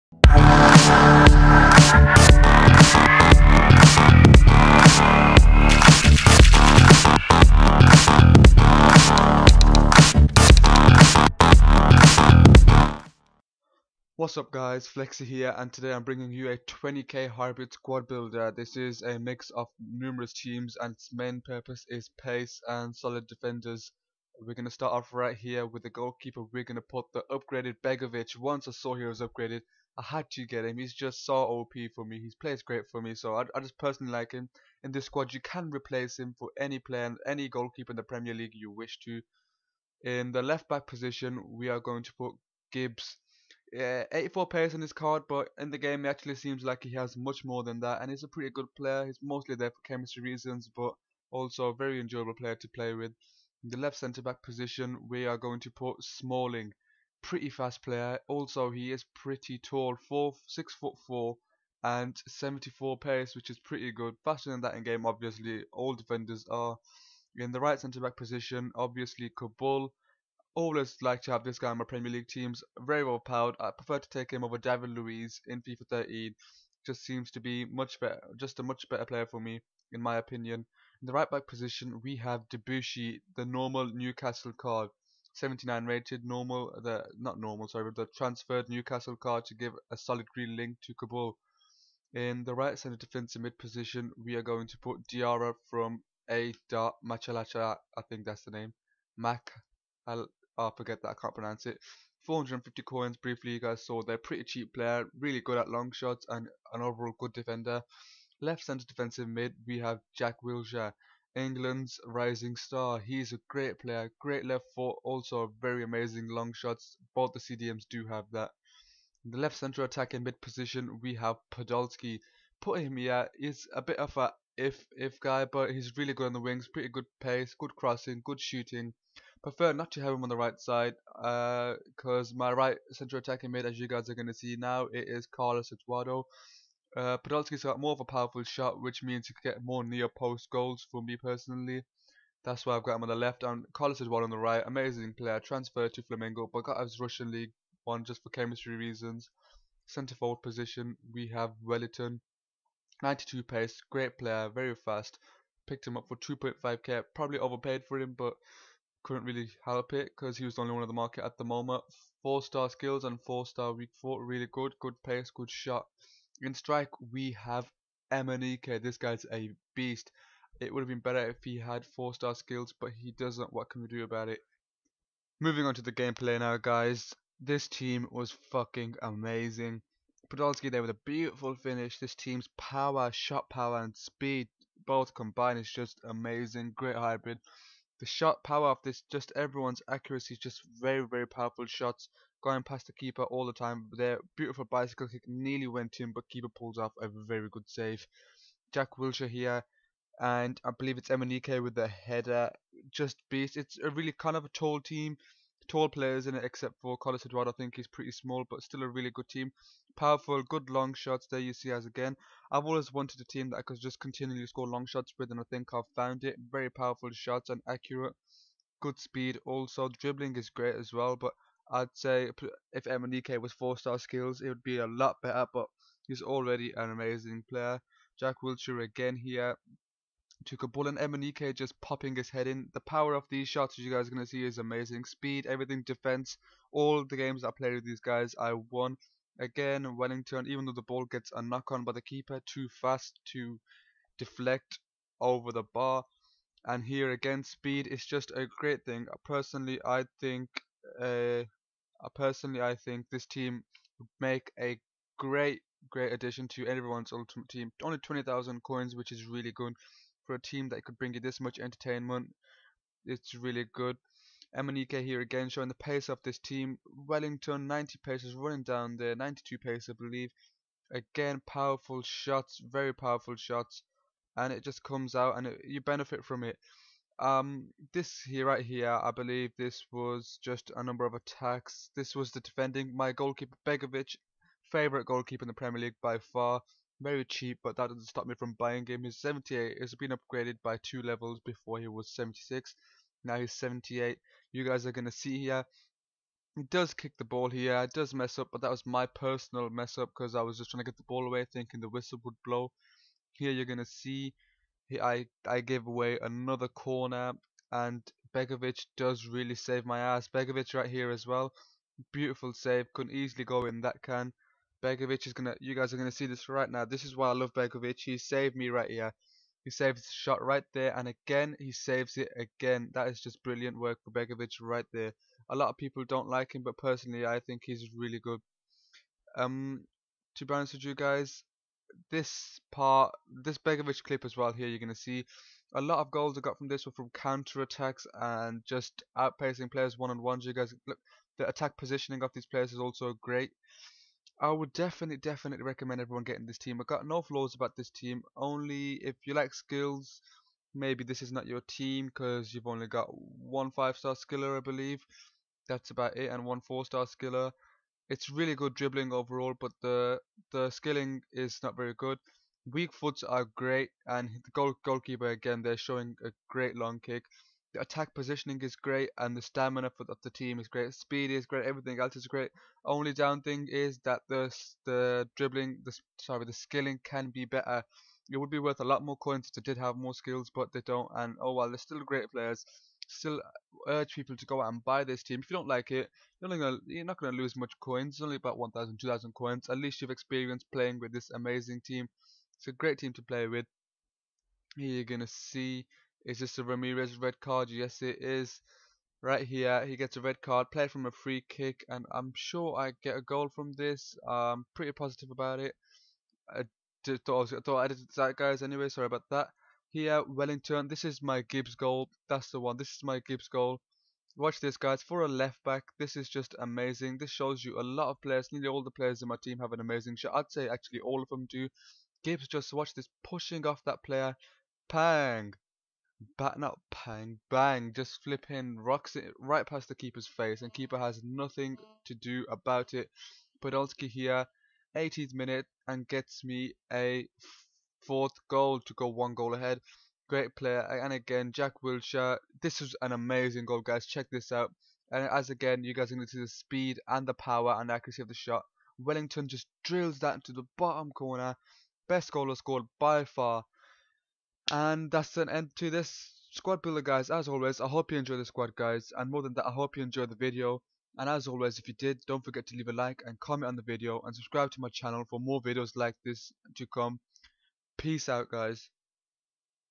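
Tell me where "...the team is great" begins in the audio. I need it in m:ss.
6:10.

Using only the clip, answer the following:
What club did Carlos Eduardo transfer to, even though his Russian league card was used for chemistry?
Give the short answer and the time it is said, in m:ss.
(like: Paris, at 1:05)
Flamengo, at 2:26.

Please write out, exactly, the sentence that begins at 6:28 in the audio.
It's only about 1,000, 2,000 coins.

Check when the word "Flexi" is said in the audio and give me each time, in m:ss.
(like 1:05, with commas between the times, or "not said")
0:14.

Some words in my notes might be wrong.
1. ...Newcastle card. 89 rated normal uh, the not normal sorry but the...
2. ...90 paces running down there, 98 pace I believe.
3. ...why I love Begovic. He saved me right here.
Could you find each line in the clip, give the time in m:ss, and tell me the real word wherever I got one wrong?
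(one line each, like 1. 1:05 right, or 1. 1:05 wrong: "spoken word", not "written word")
1. 1:23 wrong: "79", not "89"
2. 4:27 wrong: "92", not "98"
3. 5:17 right.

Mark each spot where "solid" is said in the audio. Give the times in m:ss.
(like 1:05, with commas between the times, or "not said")
0:22, 1:29.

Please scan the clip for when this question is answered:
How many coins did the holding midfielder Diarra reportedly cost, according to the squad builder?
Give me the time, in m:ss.
1:42.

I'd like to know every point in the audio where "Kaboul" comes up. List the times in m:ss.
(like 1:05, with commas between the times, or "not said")
1:09, 1:30, 3:50.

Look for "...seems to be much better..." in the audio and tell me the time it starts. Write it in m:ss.
1:17.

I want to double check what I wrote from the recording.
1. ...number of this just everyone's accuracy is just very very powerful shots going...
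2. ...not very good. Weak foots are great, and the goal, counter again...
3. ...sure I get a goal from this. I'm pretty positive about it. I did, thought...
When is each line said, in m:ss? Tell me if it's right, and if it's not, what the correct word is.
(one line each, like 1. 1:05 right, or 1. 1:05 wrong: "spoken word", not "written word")
1. 3:08 wrong: "power", not "number"
2. 6:01 wrong: "goalkeeper", not "counter"
3. 6:42 right.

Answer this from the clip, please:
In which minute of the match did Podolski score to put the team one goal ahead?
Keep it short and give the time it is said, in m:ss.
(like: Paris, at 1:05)
18th minute, at 7:14.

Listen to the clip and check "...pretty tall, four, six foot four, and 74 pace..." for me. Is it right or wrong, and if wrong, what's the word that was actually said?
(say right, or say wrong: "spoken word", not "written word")
right.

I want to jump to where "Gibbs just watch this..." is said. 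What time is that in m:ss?
7:02.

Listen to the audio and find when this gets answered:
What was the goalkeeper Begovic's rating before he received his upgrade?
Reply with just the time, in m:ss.
4:51.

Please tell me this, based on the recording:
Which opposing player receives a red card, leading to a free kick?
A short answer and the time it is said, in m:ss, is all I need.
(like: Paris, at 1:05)
Ramirez, at 6:36.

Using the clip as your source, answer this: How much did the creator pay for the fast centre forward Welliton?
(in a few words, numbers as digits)
2.5k.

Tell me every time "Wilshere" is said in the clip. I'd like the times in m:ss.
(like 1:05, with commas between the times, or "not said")
1:50, 3:18, 3:48, 7:21.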